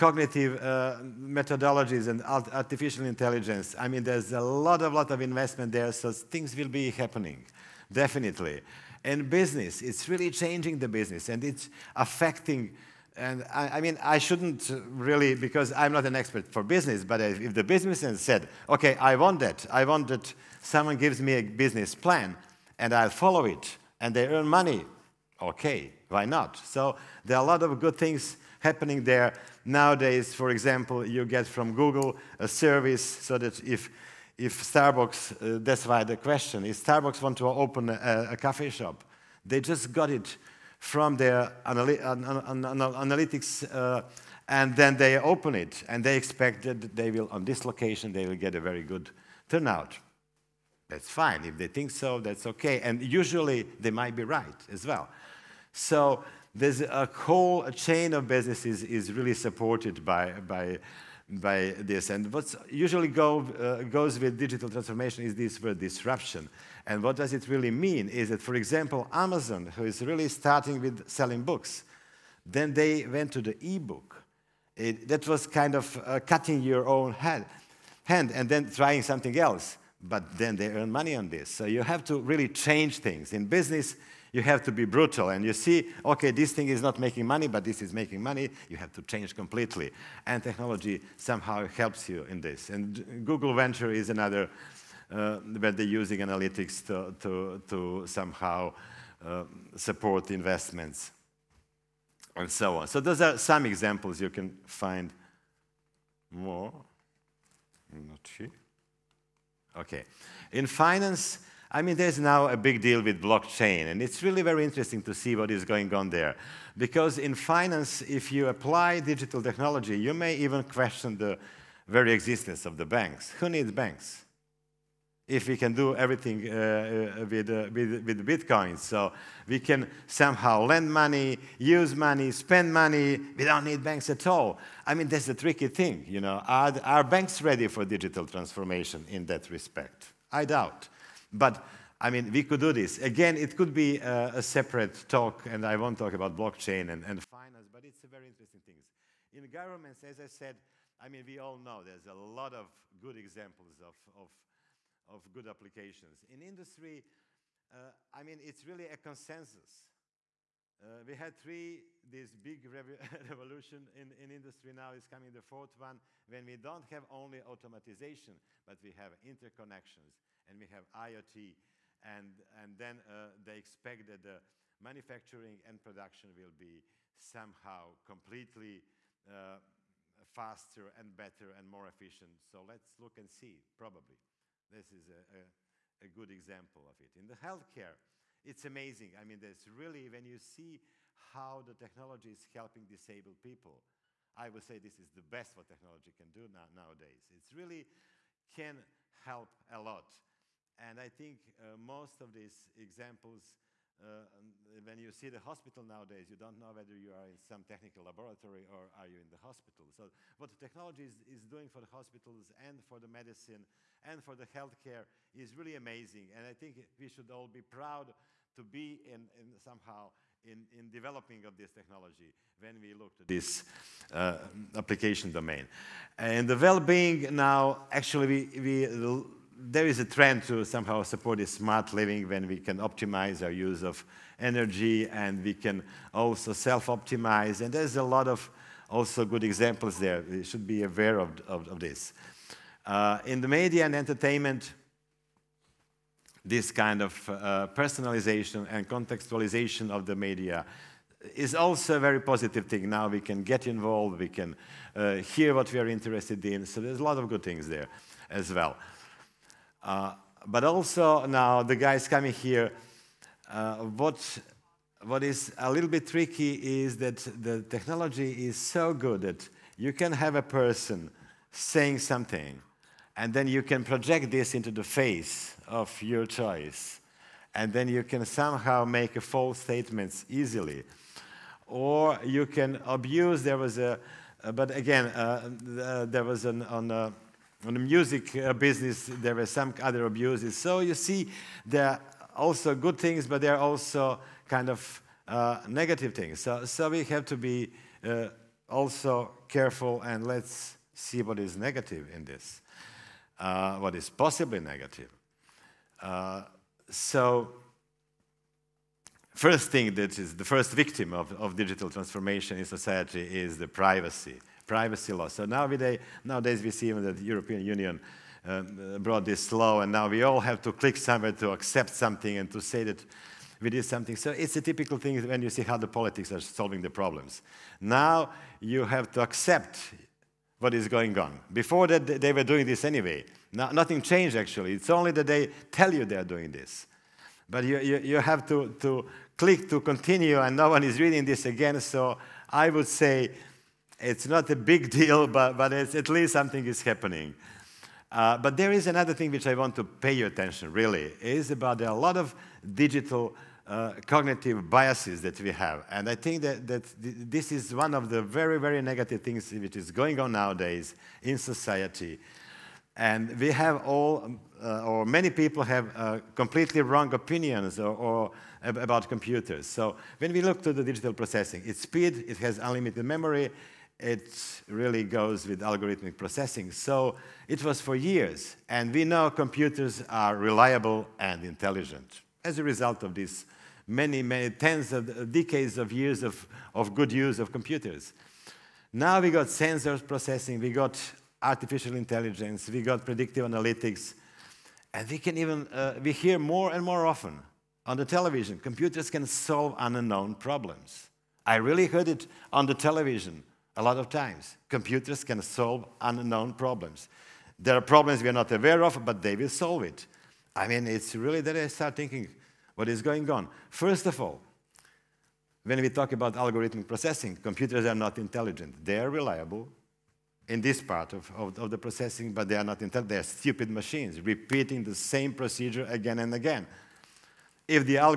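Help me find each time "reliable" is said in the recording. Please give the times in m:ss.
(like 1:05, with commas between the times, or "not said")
6:20, 6:59.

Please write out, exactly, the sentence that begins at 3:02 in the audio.
So let's look and see, probably.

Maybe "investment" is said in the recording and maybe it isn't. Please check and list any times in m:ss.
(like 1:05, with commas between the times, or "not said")
0:05, 1:40.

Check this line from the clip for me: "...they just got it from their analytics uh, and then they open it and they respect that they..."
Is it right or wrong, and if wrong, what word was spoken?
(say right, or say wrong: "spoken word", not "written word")
wrong: "expect", not "respect".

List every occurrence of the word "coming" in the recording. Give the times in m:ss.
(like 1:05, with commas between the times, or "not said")
2:45, 4:22.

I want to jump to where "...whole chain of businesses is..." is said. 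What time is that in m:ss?
0:57.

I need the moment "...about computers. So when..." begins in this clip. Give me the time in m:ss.
6:08.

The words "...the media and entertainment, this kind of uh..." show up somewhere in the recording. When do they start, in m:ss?
4:03.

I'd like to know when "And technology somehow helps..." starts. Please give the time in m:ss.
1:30.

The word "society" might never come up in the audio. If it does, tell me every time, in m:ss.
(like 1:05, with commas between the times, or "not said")
5:12, 6:01.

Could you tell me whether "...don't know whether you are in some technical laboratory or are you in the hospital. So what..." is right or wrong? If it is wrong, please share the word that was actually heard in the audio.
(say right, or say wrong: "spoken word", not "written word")
right.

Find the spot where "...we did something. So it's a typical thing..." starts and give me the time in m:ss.
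5:23.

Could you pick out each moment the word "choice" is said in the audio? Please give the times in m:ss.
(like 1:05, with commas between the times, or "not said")
4:36.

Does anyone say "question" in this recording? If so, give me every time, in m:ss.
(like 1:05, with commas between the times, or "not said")
0:36, 2:00.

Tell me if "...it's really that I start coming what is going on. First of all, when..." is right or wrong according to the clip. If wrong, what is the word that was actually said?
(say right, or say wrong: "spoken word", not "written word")
wrong: "thinking", not "coming".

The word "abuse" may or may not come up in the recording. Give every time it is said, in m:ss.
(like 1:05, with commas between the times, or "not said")
4:42, 4:50.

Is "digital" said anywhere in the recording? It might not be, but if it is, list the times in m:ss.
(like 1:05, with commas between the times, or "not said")
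1:04, 1:58, 2:17, 5:11, 5:52, 6:10.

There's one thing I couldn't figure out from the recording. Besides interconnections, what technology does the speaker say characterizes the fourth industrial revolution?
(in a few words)
IoT.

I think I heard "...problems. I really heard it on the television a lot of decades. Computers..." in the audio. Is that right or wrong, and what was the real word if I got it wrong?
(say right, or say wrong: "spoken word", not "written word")
wrong: "times", not "decades".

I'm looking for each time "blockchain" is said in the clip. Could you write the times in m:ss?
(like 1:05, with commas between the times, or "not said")
1:53, 2:26.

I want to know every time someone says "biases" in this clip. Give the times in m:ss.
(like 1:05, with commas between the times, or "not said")
5:54.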